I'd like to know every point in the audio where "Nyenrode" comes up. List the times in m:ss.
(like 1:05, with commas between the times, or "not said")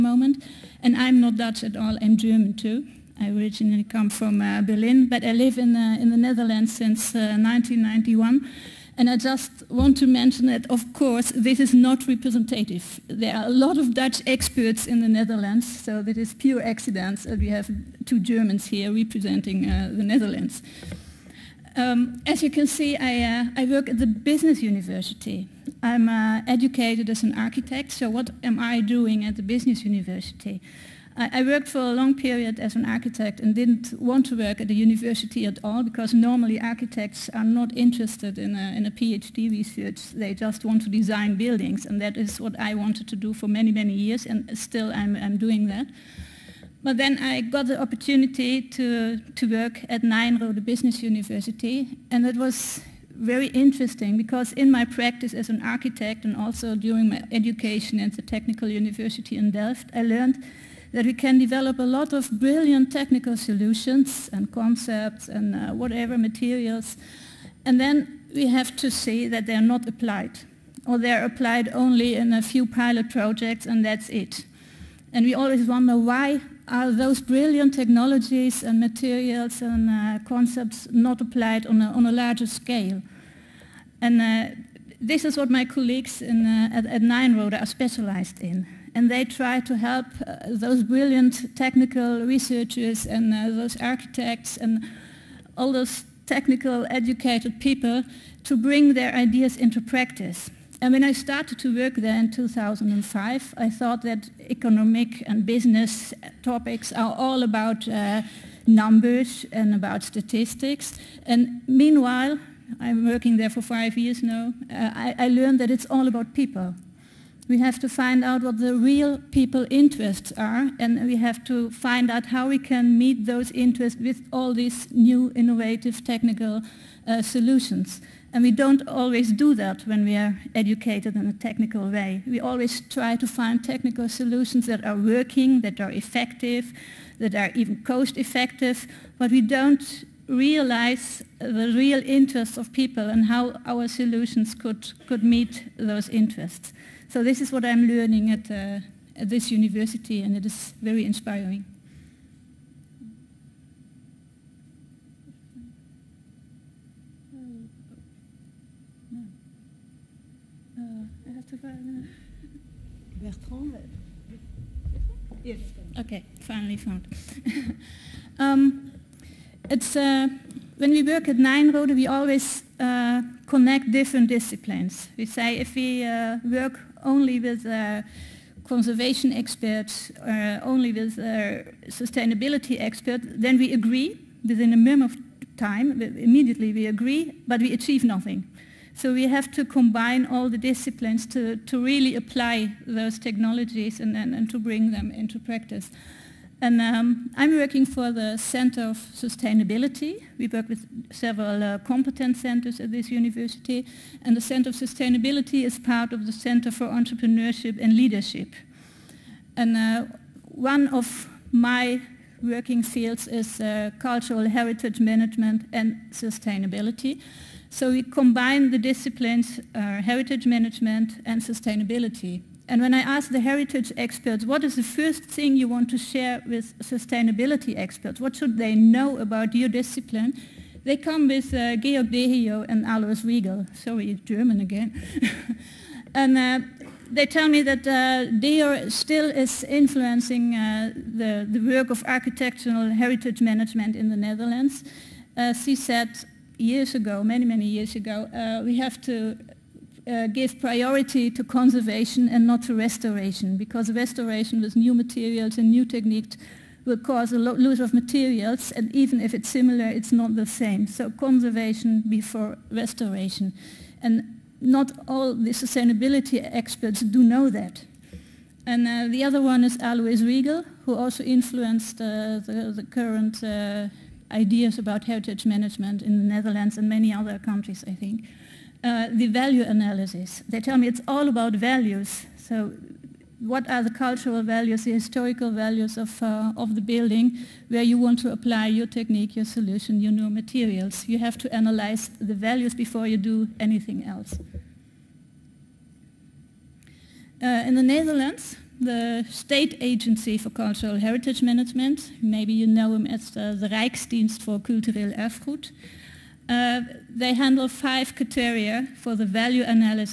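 0:50, 1:27, 2:51.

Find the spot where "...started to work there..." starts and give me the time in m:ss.
1:41.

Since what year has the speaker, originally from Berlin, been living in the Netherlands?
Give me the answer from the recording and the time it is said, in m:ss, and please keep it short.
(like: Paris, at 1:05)
1991, at 0:07.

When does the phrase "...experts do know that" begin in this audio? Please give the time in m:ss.
4:26.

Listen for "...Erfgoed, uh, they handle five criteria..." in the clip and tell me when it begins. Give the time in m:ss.
5:05.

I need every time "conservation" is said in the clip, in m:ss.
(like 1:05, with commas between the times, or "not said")
2:58, 4:11, 4:21.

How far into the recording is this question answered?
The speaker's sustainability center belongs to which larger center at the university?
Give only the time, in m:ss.
3:26.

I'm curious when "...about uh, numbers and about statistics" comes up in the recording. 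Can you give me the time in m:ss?
1:47.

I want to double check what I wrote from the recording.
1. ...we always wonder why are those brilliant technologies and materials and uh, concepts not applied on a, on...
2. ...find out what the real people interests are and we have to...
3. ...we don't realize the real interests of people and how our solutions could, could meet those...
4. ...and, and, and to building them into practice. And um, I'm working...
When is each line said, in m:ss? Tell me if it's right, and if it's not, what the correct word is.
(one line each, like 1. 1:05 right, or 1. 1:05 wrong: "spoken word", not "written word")
1. 1:15 right
2. 1:57 right
3. 2:19 right
4. 3:13 wrong: "bring", not "building".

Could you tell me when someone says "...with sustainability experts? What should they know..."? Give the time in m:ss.
3:46.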